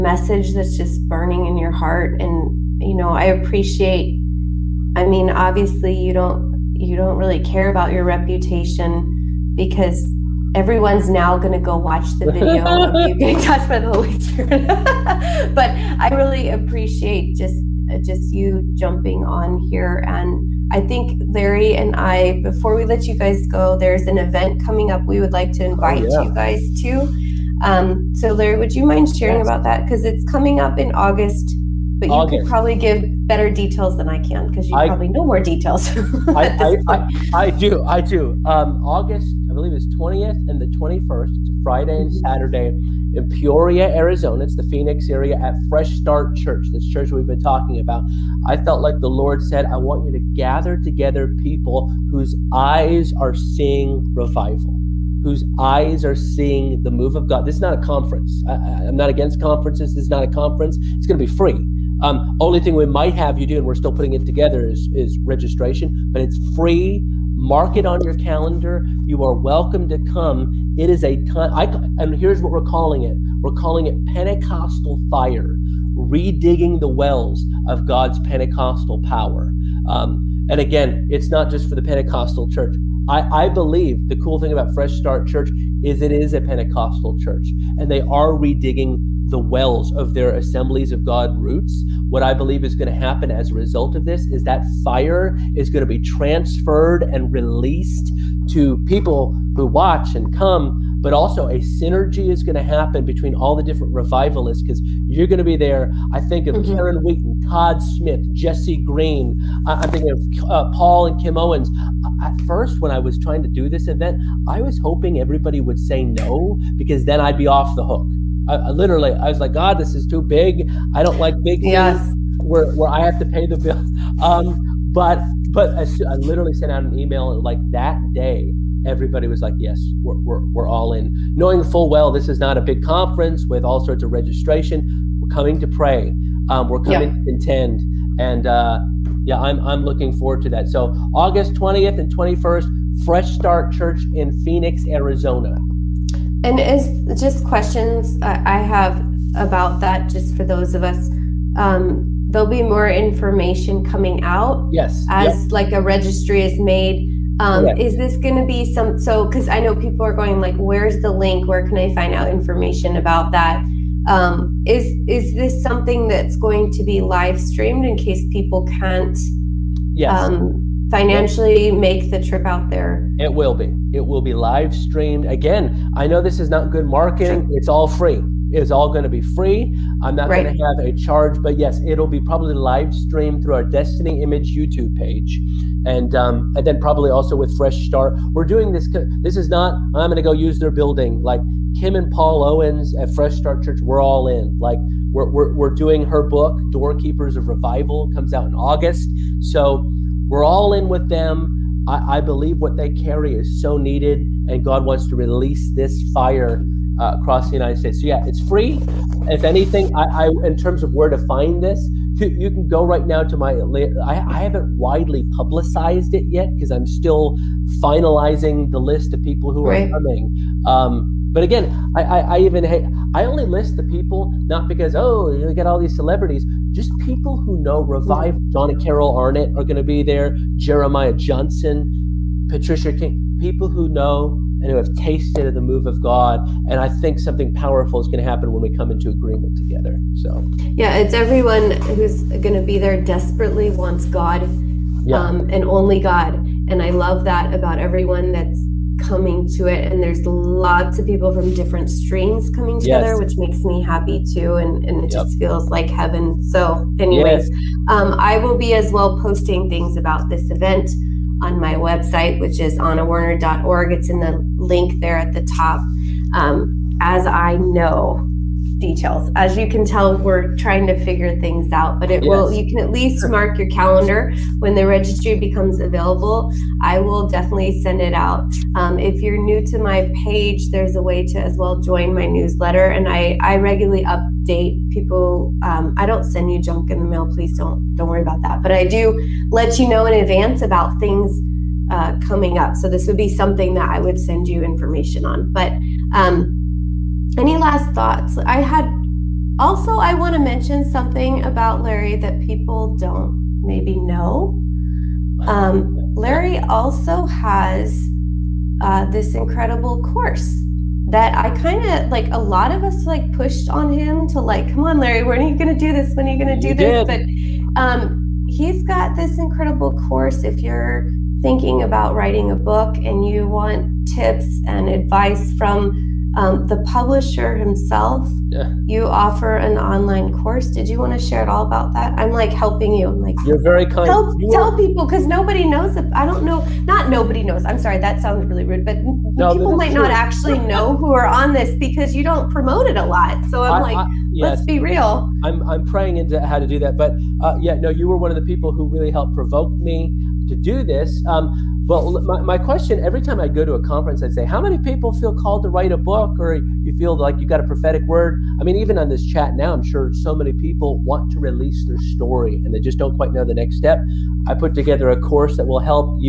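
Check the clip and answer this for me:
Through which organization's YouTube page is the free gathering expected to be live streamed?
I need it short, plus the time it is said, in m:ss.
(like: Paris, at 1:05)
Destiny Image, at 3:03.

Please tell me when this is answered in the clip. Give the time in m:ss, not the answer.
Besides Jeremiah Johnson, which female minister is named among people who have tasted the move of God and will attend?
3:52.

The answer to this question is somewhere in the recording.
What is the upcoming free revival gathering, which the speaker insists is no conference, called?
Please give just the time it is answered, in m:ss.
1:14.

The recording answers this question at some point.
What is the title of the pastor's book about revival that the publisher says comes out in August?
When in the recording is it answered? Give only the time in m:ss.
3:16.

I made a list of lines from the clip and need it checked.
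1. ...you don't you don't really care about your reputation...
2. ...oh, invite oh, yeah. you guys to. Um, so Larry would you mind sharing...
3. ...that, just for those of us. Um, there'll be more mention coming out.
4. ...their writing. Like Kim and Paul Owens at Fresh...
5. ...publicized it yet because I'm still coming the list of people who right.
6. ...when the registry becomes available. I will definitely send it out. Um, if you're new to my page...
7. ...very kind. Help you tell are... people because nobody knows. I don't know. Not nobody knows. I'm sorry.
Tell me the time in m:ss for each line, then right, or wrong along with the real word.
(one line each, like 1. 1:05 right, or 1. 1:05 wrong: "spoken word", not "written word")
1. 0:05 right
2. 0:25 right
3. 2:29 wrong: "information", not "mention"
4. 3:10 wrong: "building", not "writing"
5. 3:35 wrong: "finalizing", not "coming"
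6. 4:34 right
7. 5:33 right.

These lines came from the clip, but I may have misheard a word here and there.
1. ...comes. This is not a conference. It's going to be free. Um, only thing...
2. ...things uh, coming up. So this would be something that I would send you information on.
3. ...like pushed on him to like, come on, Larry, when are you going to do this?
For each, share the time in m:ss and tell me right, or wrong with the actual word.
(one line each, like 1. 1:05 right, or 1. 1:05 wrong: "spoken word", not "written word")
1. 0:59 wrong: "conferences", not "comes"
2. 4:50 right
3. 5:13 right.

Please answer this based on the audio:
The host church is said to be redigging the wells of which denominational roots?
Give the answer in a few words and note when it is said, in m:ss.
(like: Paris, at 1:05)
Assemblies of God, at 1:30.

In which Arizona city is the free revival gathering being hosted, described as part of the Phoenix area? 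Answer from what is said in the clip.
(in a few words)
Peoria.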